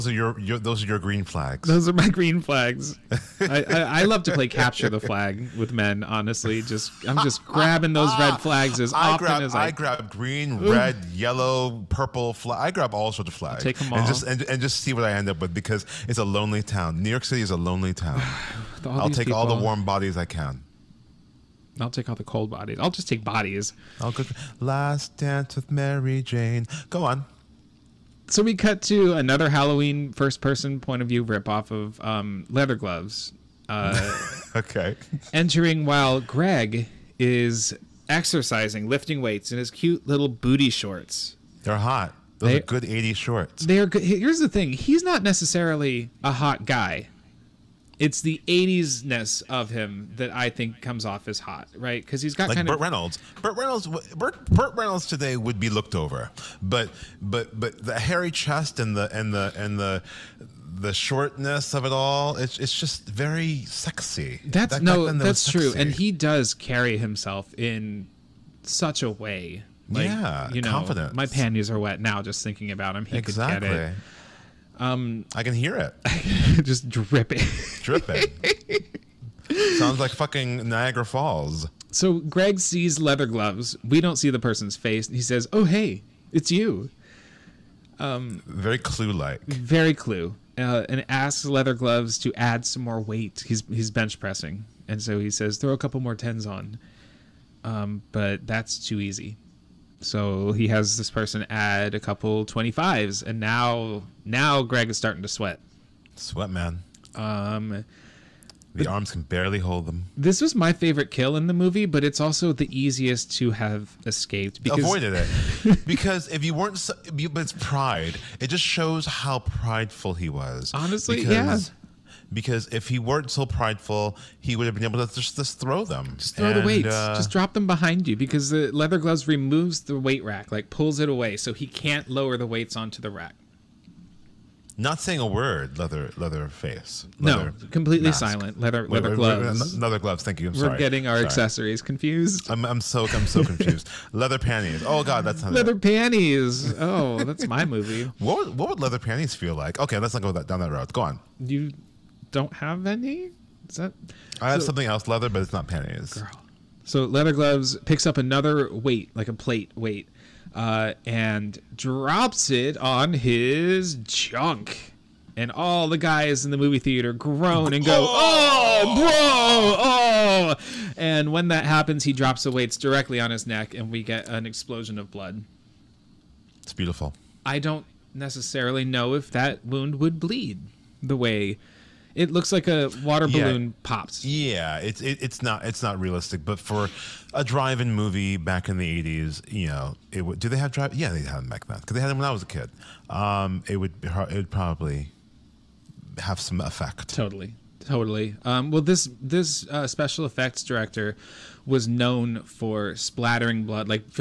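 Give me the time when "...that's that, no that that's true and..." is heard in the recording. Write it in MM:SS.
01:04.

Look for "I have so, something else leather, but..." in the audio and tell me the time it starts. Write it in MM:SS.
02:34.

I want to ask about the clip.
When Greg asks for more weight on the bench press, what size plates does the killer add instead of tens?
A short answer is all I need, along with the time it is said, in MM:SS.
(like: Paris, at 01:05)
25s, at 01:42.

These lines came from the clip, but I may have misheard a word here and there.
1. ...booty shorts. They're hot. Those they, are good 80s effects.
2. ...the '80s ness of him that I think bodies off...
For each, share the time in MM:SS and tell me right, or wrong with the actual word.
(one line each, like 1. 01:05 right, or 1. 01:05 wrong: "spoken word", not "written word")
1. 00:40 wrong: "shorts", not "effects"
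2. 00:48 wrong: "comes", not "bodies".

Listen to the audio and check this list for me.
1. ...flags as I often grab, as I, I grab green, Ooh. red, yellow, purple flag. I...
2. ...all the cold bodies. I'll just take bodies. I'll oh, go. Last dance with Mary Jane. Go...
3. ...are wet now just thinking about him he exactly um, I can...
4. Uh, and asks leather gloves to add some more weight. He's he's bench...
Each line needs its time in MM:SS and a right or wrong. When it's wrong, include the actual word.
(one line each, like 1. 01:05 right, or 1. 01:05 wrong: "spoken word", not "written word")
1. 00:08 right
2. 00:22 right
3. 01:11 right
4. 01:30 right.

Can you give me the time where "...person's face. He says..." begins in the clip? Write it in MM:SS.
01:24.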